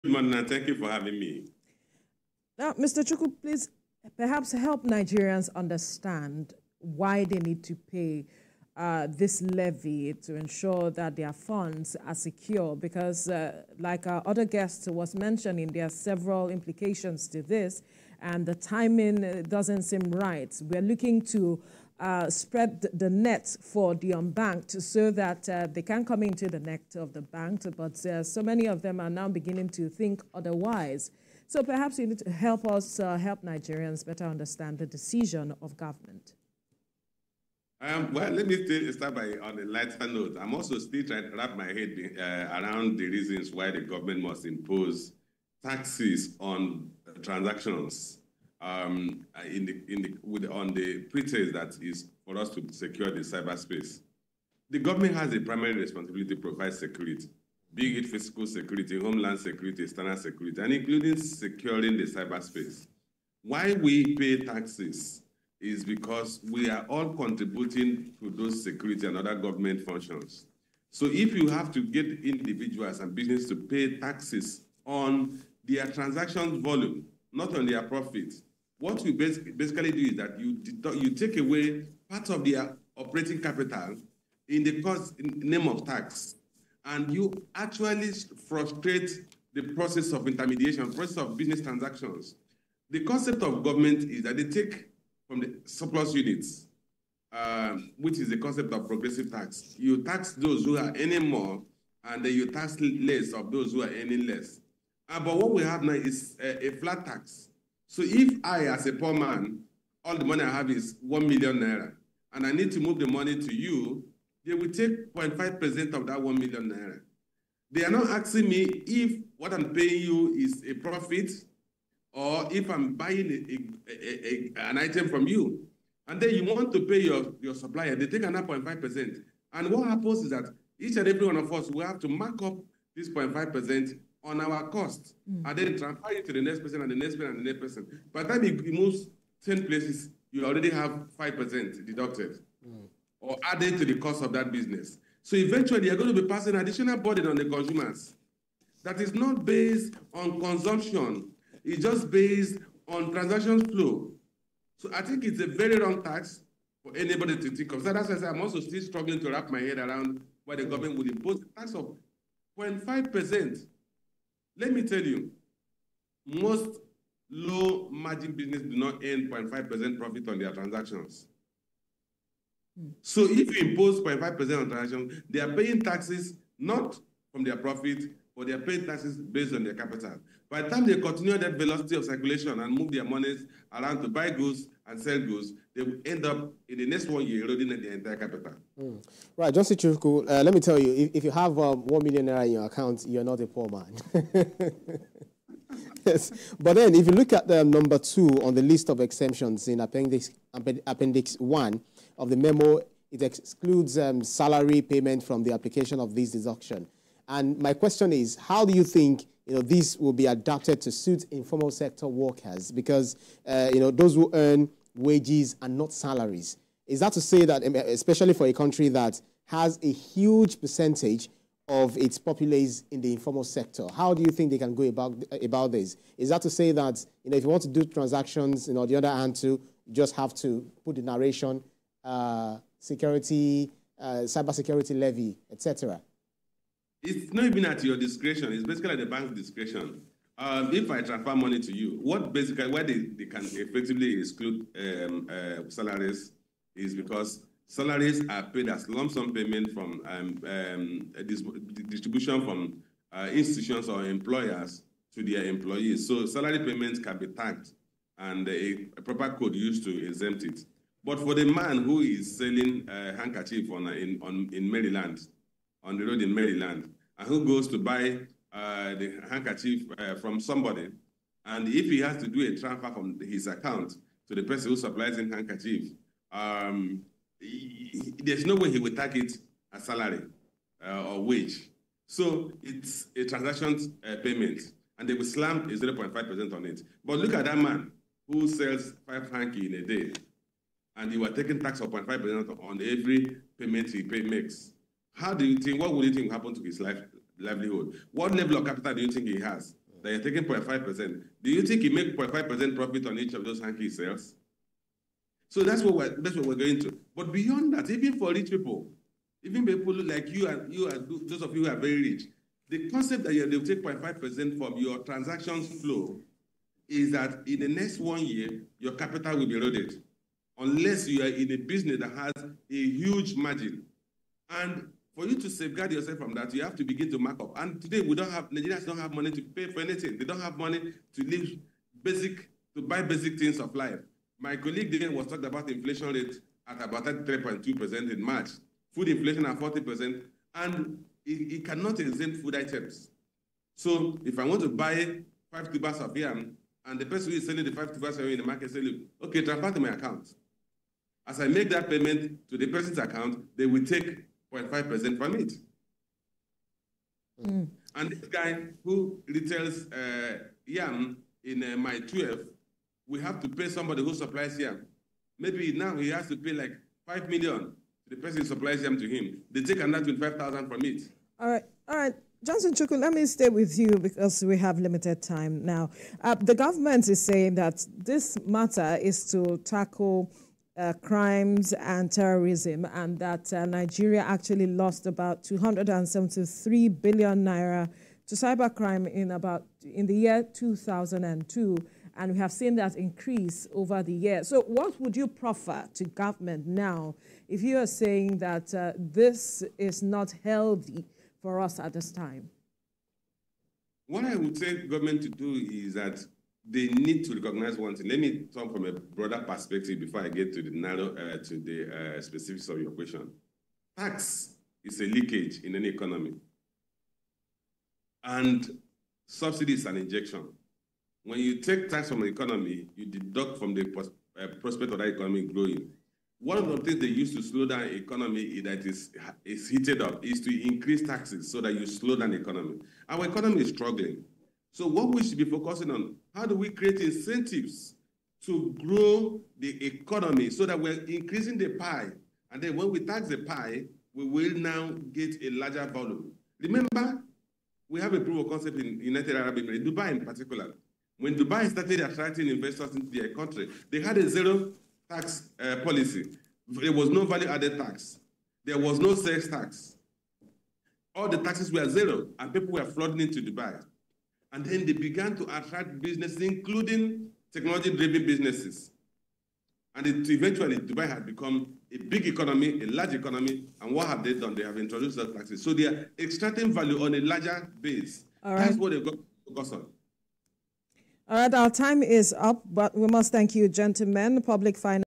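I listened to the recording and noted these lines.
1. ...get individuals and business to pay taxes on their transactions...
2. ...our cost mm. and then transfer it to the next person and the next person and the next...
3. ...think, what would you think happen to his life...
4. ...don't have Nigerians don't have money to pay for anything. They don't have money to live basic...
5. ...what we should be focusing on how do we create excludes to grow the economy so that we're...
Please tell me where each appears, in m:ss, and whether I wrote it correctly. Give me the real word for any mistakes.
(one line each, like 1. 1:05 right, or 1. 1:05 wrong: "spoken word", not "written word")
1. 1:11 right
2. 2:14 right
3. 4:55 right
4. 5:28 right
5. 7:14 wrong: "incentives", not "excludes".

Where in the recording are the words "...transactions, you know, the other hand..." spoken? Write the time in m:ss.
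3:47.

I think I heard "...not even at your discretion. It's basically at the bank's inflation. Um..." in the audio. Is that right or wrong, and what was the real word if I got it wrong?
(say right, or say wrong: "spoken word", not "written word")
wrong: "discretion", not "inflation".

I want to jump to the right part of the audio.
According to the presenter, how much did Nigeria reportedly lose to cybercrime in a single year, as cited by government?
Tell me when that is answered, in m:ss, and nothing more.
6:25.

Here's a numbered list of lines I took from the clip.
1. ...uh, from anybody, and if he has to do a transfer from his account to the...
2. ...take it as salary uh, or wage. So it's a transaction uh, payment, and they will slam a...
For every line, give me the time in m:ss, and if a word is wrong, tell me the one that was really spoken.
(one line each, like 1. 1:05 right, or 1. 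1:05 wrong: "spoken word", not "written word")
1. 4:29 wrong: "somebody", not "anybody"
2. 4:38 right.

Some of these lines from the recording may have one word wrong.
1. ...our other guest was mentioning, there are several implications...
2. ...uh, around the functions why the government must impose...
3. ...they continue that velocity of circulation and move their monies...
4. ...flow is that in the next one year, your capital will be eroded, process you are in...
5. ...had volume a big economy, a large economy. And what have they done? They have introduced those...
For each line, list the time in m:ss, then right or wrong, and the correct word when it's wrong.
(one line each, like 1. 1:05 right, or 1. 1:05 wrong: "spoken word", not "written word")
1. 0:14 right
2. 0:42 wrong: "reasons", not "functions"
3. 3:00 right
4. 5:15 wrong: "unless", not "process"
5. 7:51 wrong: "become", not "volume".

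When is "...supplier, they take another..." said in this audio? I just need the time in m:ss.
2:07.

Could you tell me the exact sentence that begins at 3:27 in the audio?
And my question is, how do you think you know, this will be adapted to suit informal sector workers?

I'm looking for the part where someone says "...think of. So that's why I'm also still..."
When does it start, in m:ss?
2:37.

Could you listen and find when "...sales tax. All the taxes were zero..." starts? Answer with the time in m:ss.
7:39.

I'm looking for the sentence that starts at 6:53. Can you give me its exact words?
Tax is a leakage in any economy, and subsidy is an injection.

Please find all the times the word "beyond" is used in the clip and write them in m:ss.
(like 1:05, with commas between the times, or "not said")
5:07.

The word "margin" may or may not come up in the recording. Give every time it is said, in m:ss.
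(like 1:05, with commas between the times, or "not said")
2:47, 5:23.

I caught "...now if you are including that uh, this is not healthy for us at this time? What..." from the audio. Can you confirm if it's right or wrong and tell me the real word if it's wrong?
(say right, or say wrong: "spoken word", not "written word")
wrong: "saying", not "including".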